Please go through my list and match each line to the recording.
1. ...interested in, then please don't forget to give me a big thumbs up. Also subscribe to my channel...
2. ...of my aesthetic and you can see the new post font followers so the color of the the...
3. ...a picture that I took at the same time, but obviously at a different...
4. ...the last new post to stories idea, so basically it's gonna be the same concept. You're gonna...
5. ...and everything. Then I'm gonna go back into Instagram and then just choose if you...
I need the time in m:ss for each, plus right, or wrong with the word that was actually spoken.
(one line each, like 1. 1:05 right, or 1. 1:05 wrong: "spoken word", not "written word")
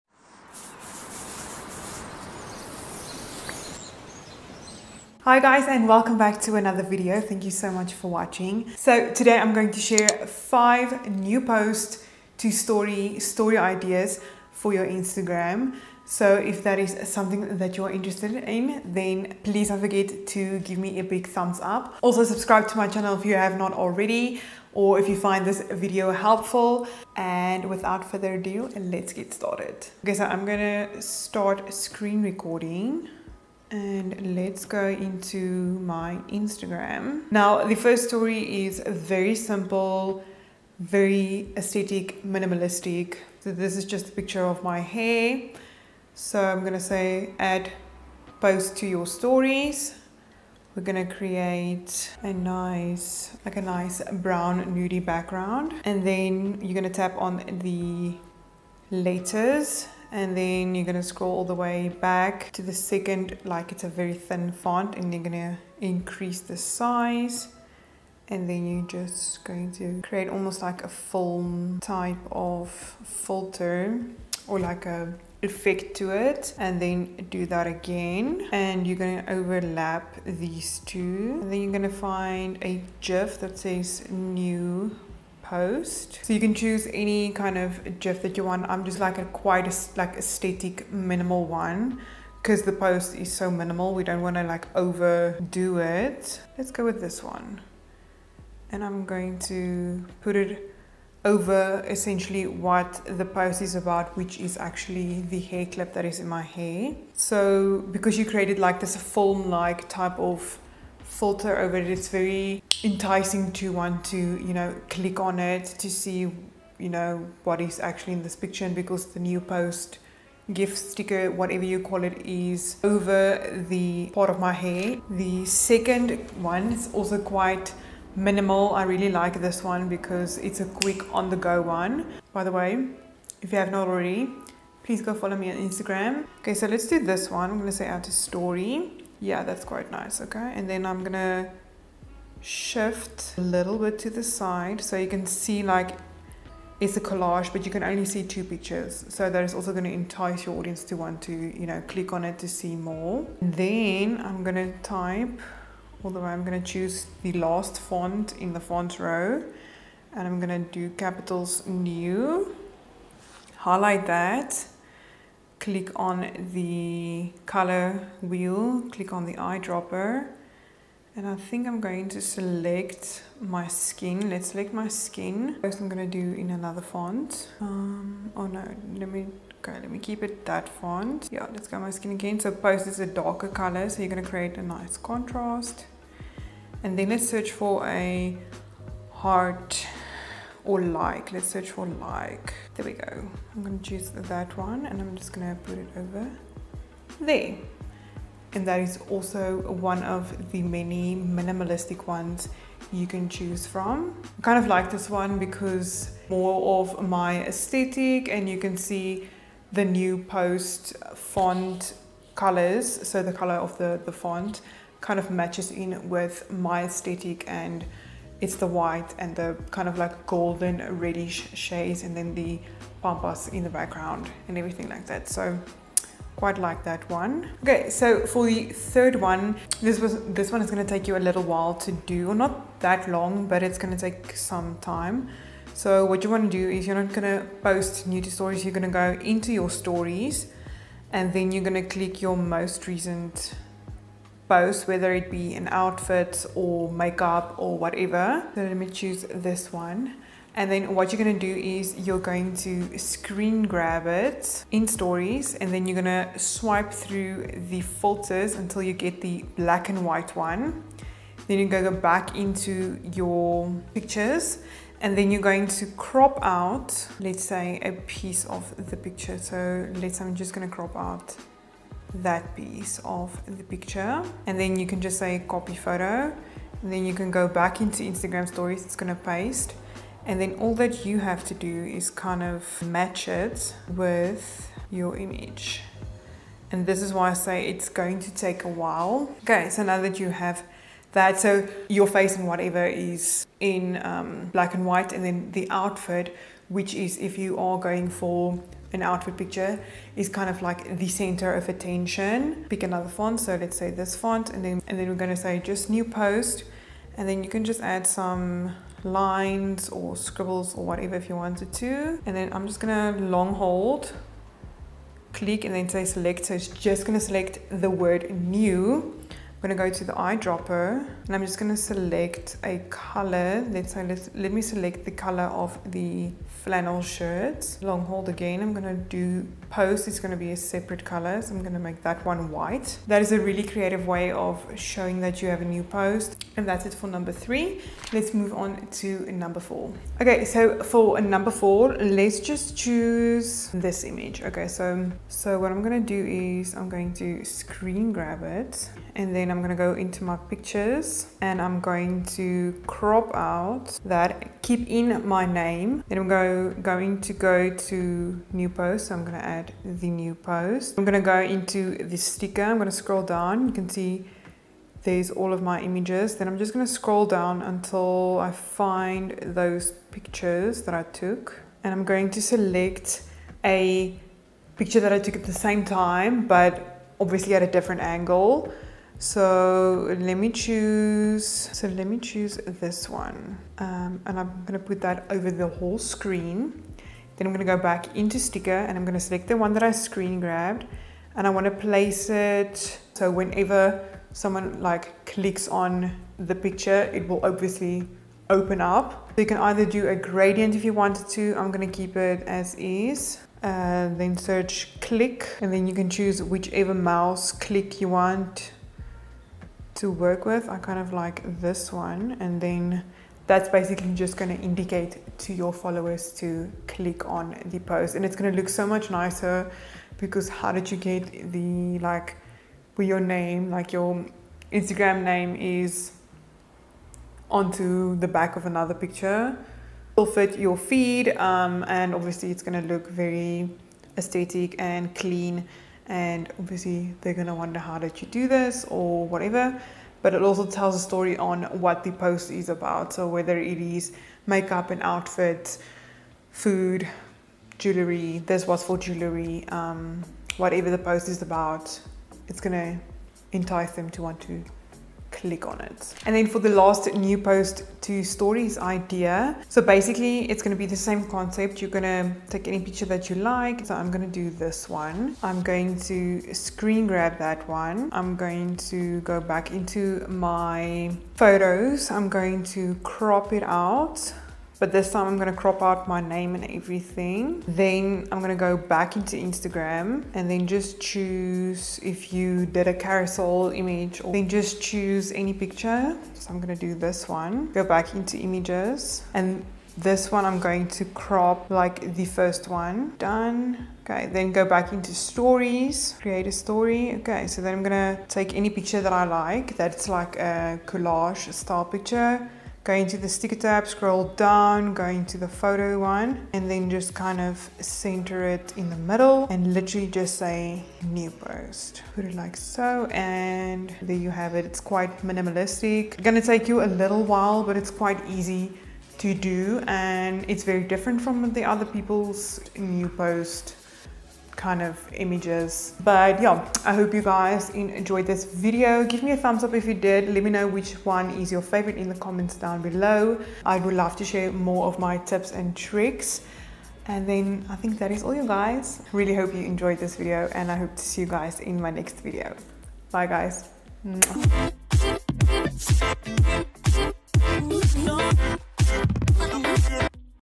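1. 0:17 right
2. 3:26 wrong: "colors", not "followers"
3. 6:13 right
4. 7:36 right
5. 7:56 right.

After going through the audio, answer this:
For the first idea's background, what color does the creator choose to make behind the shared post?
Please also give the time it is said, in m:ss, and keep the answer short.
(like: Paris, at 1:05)
Brown nudie, at 0:54.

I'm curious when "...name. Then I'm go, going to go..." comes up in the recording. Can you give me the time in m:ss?
5:55.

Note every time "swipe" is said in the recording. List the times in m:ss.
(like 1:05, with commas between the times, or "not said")
4:16.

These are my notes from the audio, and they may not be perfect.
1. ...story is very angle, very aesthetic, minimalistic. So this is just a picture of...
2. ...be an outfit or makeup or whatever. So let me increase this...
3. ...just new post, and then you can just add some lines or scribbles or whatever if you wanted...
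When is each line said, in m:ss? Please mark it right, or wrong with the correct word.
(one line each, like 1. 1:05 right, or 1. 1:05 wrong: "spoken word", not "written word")
1. 0:38 wrong: "simple", not "angle"
2. 4:05 wrong: "choose", not "increase"
3. 5:05 right.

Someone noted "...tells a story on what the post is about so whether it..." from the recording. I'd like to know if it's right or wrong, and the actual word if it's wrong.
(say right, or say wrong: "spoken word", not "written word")
right.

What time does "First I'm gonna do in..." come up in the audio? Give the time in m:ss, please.
2:55.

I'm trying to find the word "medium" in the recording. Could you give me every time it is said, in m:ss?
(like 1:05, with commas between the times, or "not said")
not said.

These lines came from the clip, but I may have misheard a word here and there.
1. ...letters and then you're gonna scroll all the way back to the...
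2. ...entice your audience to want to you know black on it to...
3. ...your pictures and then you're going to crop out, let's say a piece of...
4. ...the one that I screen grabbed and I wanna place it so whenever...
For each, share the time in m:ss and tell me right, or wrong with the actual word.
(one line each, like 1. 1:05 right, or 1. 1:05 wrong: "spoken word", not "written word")
1. 0:58 right
2. 2:29 wrong: "click", not "black"
3. 4:23 right
4. 6:29 right.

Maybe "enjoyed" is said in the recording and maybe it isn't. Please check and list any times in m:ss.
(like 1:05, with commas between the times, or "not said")
8:47, 8:59.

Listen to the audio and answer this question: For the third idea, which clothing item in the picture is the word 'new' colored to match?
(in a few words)
Flannel shirt.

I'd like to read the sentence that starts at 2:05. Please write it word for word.
The second one is also quite minimal.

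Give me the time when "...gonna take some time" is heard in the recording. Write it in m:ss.
3:53.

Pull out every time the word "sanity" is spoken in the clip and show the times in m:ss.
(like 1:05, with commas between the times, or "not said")
not said.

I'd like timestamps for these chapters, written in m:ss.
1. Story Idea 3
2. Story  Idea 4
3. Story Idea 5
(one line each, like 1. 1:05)
1. 3:47
2. 5:37
3. 7:36.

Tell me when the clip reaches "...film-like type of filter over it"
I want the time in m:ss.
1:48.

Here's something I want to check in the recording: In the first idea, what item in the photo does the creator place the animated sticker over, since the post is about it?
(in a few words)
Hair clip.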